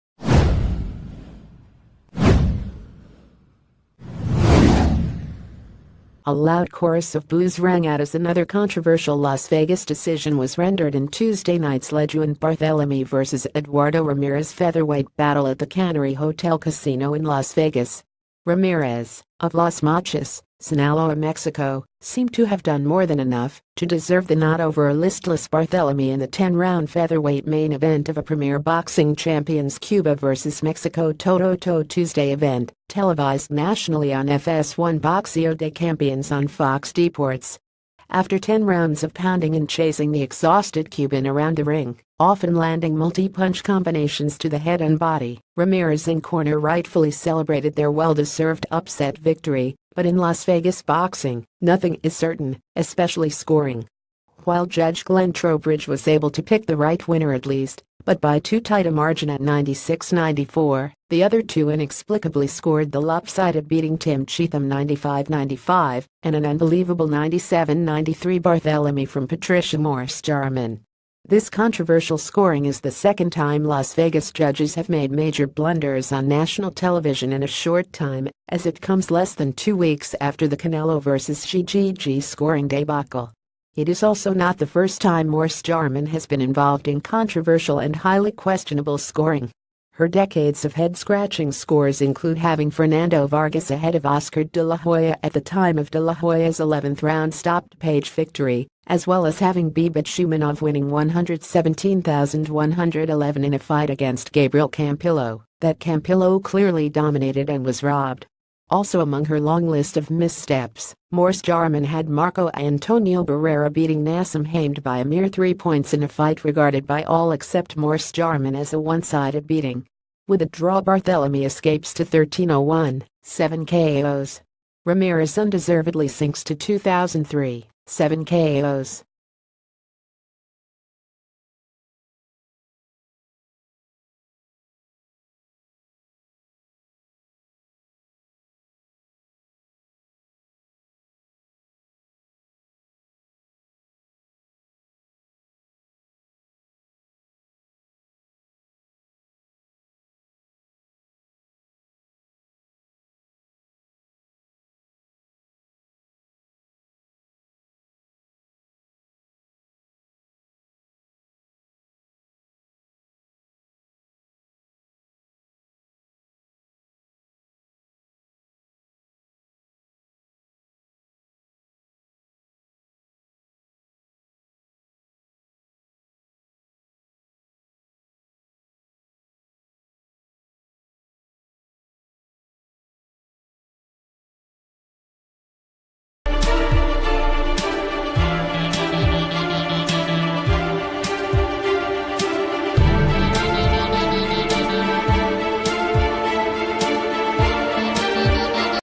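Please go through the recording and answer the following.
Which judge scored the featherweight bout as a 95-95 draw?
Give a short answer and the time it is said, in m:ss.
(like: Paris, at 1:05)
Tim Cheatham, at 1:03.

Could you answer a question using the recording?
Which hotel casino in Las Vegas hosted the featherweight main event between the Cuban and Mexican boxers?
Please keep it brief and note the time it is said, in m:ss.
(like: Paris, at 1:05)
Cannery Hotel Casino, at 0:15.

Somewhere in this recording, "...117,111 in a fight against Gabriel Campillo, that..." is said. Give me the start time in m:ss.
1:40.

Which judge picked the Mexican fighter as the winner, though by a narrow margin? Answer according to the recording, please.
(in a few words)
Glenn Trowbridge.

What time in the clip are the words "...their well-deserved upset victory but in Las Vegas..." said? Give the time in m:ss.
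0:47.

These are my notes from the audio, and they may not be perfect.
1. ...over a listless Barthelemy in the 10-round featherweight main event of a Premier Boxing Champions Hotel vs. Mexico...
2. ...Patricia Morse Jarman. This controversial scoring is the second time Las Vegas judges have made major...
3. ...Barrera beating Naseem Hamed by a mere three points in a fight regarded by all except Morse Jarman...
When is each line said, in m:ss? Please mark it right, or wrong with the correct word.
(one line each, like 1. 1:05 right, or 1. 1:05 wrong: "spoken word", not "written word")
1. 0:24 wrong: "Cuba", not "Hotel"
2. 1:09 right
3. 1:53 right.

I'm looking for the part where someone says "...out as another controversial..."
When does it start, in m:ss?
0:07.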